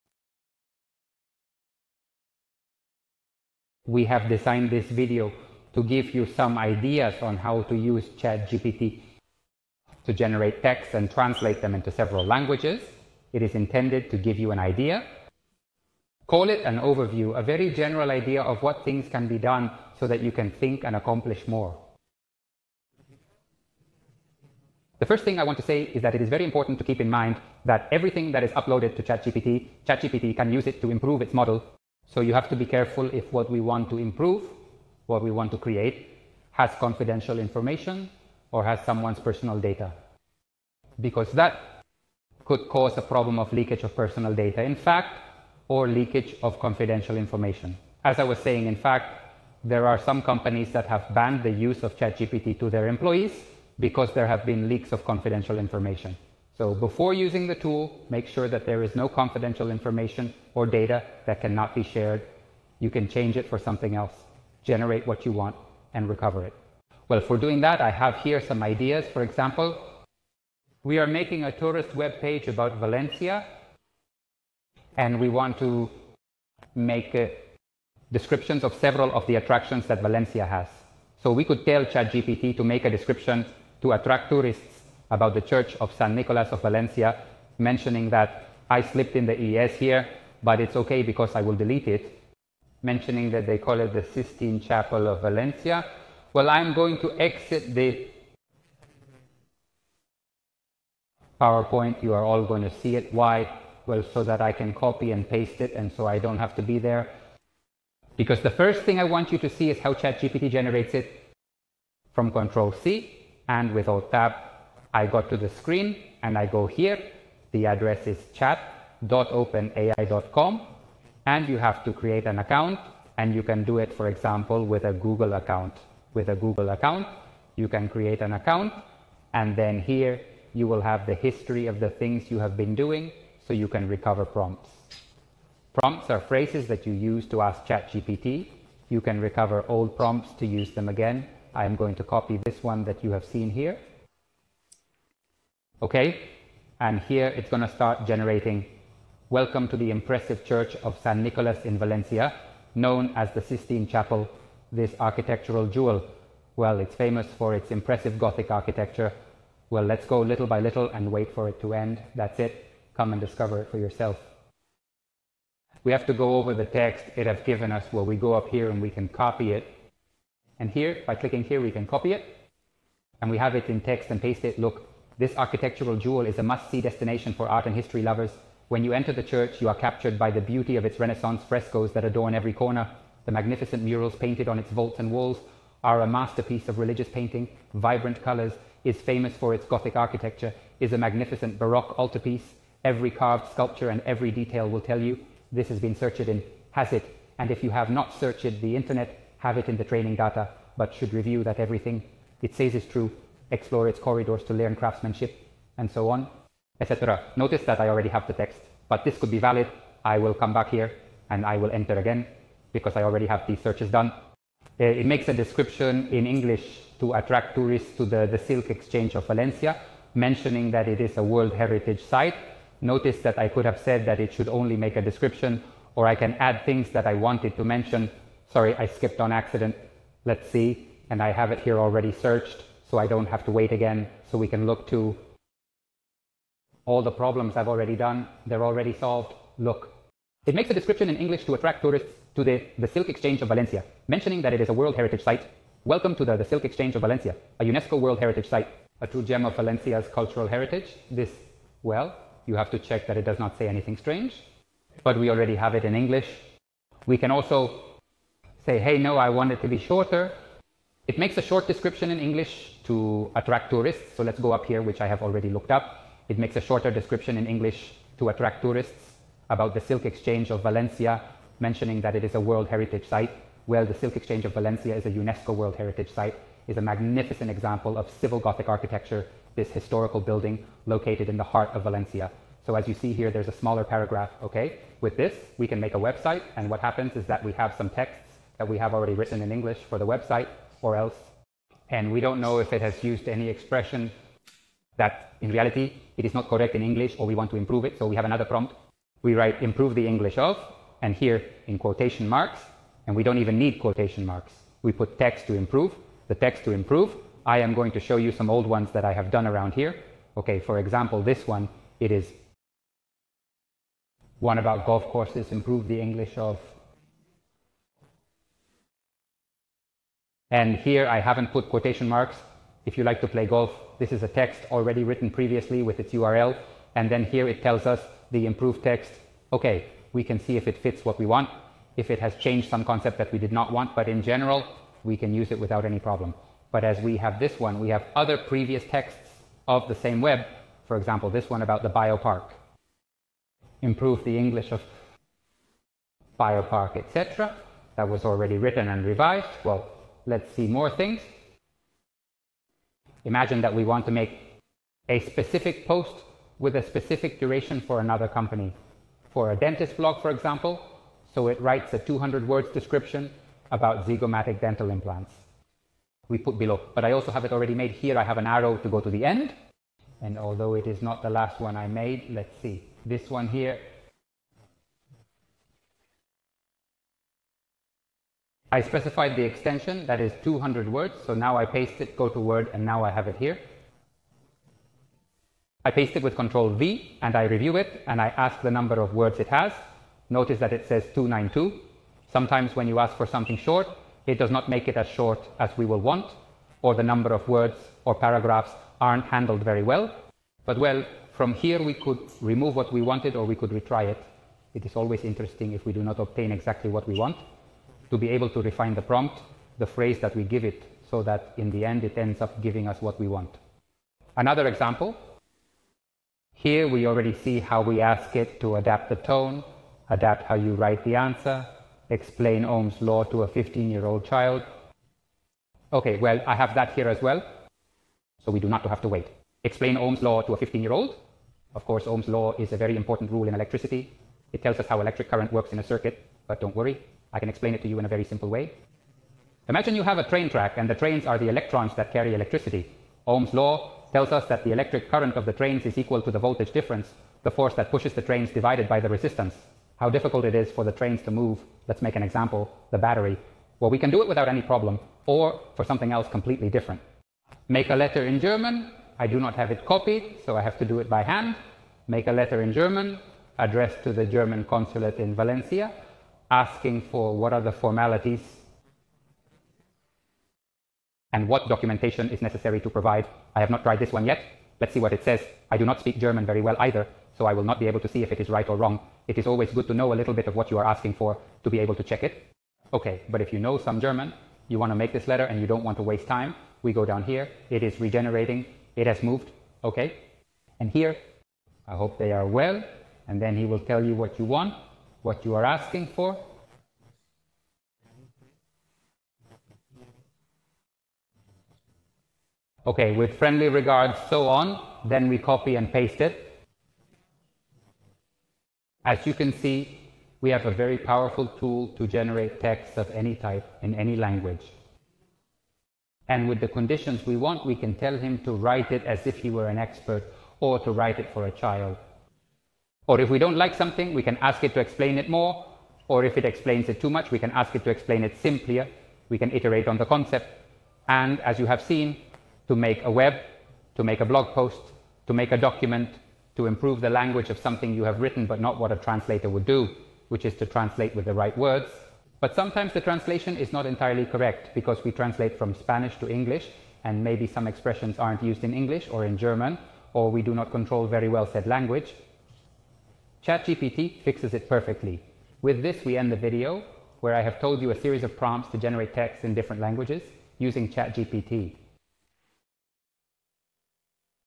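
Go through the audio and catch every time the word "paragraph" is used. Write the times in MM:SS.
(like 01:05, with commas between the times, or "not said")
04:43, 06:38.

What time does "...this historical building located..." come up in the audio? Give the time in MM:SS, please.
04:39.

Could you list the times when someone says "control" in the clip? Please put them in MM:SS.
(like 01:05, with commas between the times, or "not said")
01:52, 06:26, 09:10.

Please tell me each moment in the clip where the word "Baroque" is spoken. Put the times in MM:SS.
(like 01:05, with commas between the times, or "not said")
03:11.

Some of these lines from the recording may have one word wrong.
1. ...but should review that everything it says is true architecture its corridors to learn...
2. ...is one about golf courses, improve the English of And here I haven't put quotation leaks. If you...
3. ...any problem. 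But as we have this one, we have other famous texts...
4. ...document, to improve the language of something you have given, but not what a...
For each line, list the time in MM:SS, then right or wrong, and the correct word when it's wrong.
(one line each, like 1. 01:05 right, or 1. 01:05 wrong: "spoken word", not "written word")
1. 03:20 wrong: "explore", not "architecture"
2. 05:12 wrong: "marks", not "leaks"
3. 05:35 wrong: "previous", not "famous"
4. 08:55 wrong: "written", not "given".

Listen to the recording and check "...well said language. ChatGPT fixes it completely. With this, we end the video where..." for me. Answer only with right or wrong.
wrong.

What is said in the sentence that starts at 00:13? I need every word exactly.
It is intended to give you an idea.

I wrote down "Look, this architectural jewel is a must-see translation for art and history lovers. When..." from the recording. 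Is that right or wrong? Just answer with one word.
wrong.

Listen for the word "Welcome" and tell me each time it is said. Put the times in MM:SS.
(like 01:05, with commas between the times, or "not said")
02:29, 04:05.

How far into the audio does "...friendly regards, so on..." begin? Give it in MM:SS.
08:23.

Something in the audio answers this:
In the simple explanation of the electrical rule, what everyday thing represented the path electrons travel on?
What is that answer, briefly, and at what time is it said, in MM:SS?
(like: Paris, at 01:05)
train track, at 07:20.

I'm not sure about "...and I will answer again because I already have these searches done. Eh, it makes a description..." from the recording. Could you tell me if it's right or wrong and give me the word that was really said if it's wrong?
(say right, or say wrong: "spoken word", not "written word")
wrong: "enter", not "answer".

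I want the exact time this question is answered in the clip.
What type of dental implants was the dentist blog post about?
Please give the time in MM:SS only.
06:04.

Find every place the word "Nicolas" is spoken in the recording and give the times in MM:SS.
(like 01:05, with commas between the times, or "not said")
01:26, 02:31.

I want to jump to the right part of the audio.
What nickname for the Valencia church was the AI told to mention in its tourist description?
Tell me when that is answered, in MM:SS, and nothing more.
01:34.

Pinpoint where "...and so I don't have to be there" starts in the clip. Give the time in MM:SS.
01:45.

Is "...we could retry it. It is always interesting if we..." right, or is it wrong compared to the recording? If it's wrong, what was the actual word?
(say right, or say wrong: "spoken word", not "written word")
right.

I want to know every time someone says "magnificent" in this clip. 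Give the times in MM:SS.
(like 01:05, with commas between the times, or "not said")
03:03, 03:11, 04:36.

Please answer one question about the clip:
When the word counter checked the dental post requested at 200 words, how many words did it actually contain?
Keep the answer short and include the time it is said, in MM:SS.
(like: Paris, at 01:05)
292, at 06:31.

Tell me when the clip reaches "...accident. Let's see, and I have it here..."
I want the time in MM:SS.
03:49.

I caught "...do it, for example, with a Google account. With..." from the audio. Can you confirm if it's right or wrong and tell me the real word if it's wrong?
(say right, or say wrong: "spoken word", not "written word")
right.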